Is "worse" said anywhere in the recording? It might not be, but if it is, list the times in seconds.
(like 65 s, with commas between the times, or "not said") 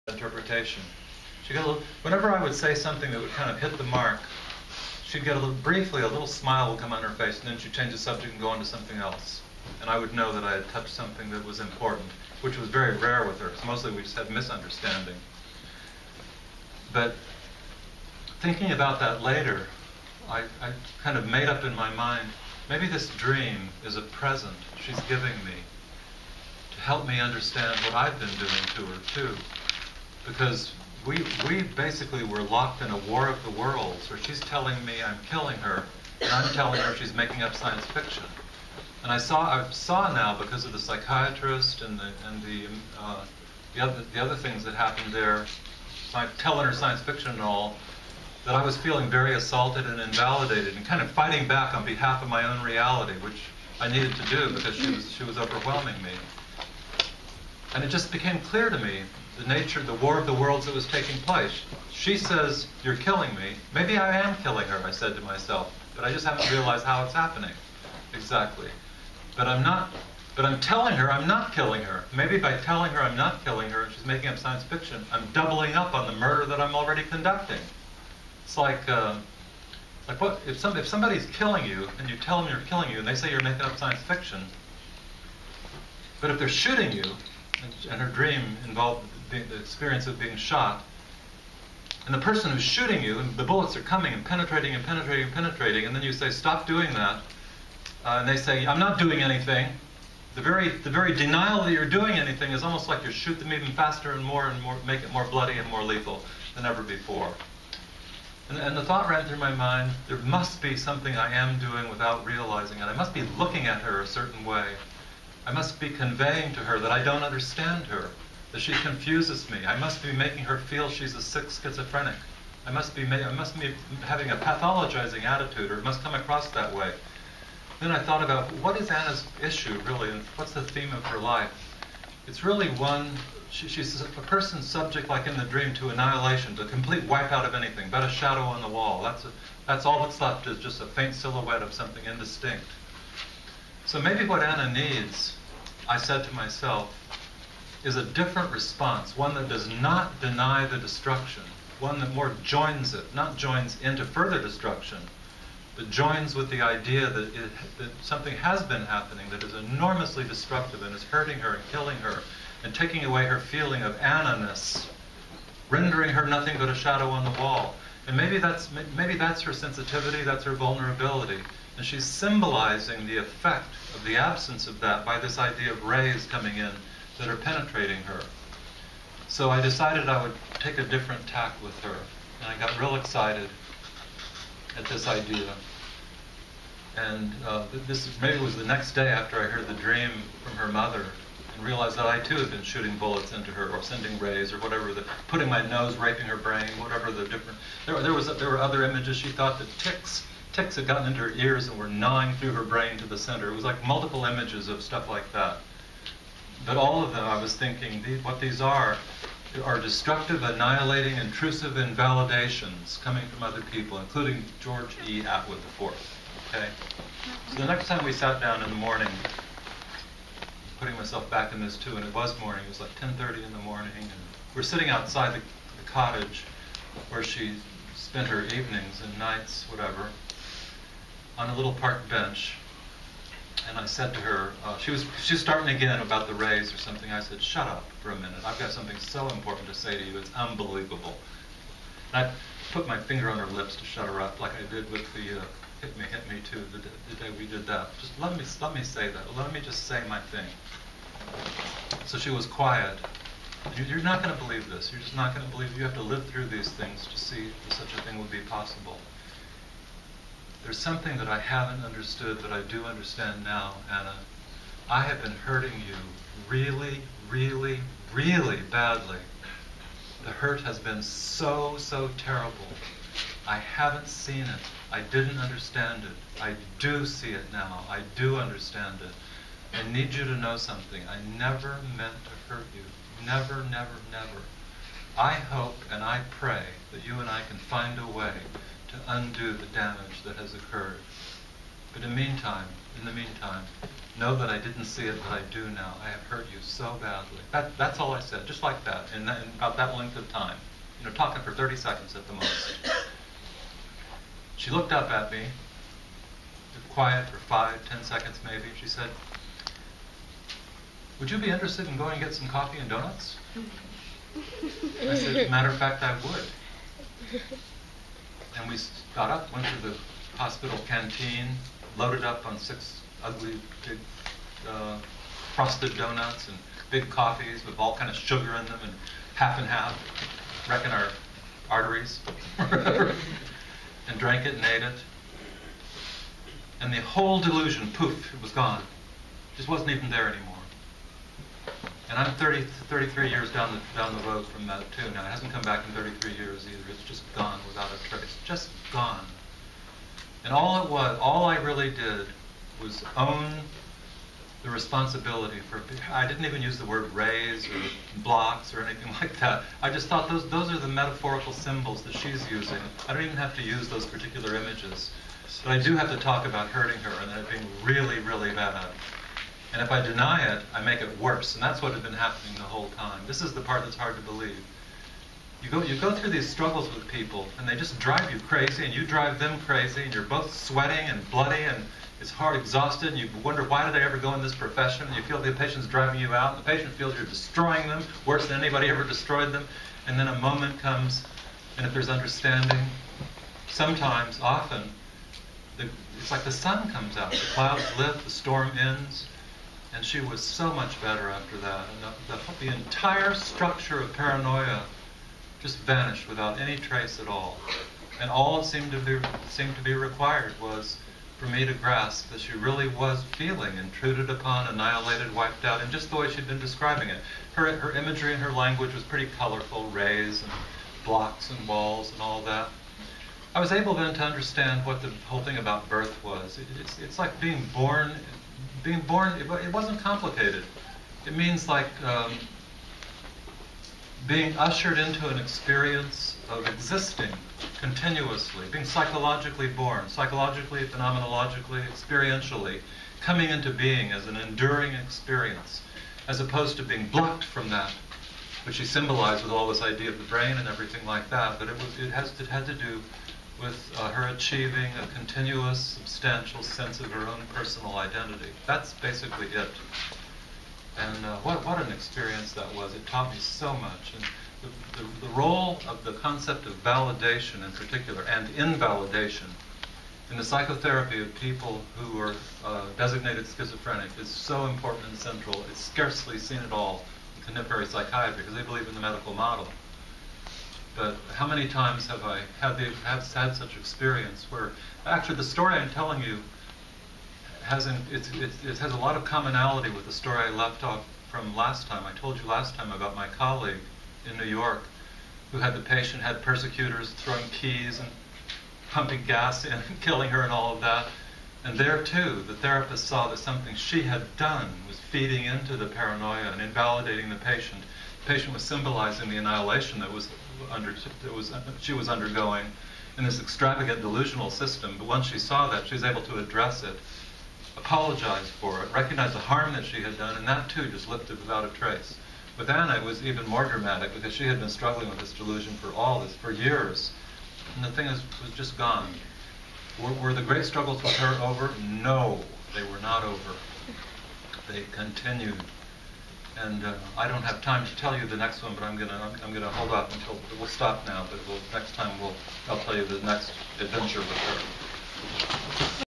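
371 s, 388 s.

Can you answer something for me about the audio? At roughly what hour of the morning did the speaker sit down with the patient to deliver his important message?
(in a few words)
10:30.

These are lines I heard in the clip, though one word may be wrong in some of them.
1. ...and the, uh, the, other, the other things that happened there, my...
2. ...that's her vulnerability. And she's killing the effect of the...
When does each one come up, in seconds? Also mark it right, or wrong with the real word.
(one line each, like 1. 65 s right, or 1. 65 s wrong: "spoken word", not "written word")
1. 42 s right
2. 170 s wrong: "symbolizing", not "killing".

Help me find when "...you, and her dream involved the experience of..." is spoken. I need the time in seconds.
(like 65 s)
86 s.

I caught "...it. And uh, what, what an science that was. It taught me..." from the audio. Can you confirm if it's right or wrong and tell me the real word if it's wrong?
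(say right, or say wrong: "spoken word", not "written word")
wrong: "experience", not "science".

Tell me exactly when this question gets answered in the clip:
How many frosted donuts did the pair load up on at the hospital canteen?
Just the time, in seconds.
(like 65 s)
322 s.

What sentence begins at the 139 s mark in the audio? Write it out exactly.
That's a, that's all that's left is just a faint silhouette of something indistinct.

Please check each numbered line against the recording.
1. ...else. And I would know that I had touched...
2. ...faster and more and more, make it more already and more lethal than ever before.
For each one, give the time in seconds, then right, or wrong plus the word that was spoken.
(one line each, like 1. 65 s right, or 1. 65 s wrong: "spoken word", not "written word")
1. 8 s right
2. 103 s wrong: "bloody", not "already".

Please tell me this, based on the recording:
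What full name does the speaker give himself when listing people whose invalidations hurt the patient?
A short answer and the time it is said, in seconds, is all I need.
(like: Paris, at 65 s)
George E. Atwood IV, at 214 s.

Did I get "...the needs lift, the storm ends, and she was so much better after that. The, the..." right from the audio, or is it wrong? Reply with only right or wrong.
wrong.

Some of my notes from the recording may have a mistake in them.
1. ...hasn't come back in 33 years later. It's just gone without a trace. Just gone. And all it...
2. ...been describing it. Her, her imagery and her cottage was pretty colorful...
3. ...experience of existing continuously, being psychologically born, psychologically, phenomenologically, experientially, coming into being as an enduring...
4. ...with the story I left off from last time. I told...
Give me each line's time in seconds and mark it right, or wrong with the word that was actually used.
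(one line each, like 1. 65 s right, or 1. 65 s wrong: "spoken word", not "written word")
1. 345 s wrong: "either", not "later"
2. 416 s wrong: "language", not "cottage"
3. 435 s right
4. 489 s right.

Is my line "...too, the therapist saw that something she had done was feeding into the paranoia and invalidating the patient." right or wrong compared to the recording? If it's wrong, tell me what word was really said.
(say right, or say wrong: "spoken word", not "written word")
right.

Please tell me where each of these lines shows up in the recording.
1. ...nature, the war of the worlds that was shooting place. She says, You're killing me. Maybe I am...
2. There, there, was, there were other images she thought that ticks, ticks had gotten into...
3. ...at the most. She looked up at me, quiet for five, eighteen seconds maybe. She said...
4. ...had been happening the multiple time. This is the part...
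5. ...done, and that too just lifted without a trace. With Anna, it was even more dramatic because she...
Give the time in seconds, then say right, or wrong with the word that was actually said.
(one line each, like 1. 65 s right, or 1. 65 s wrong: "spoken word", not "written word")
1. 59 s wrong: "taking", not "shooting"
2. 197 s right
3. 302 s wrong: "ten", not "eighteen"
4. 371 s wrong: "whole", not "multiple"
5. 520 s right.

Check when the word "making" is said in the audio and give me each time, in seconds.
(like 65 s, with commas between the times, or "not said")
37 s, 74 s, 83 s, 120 s.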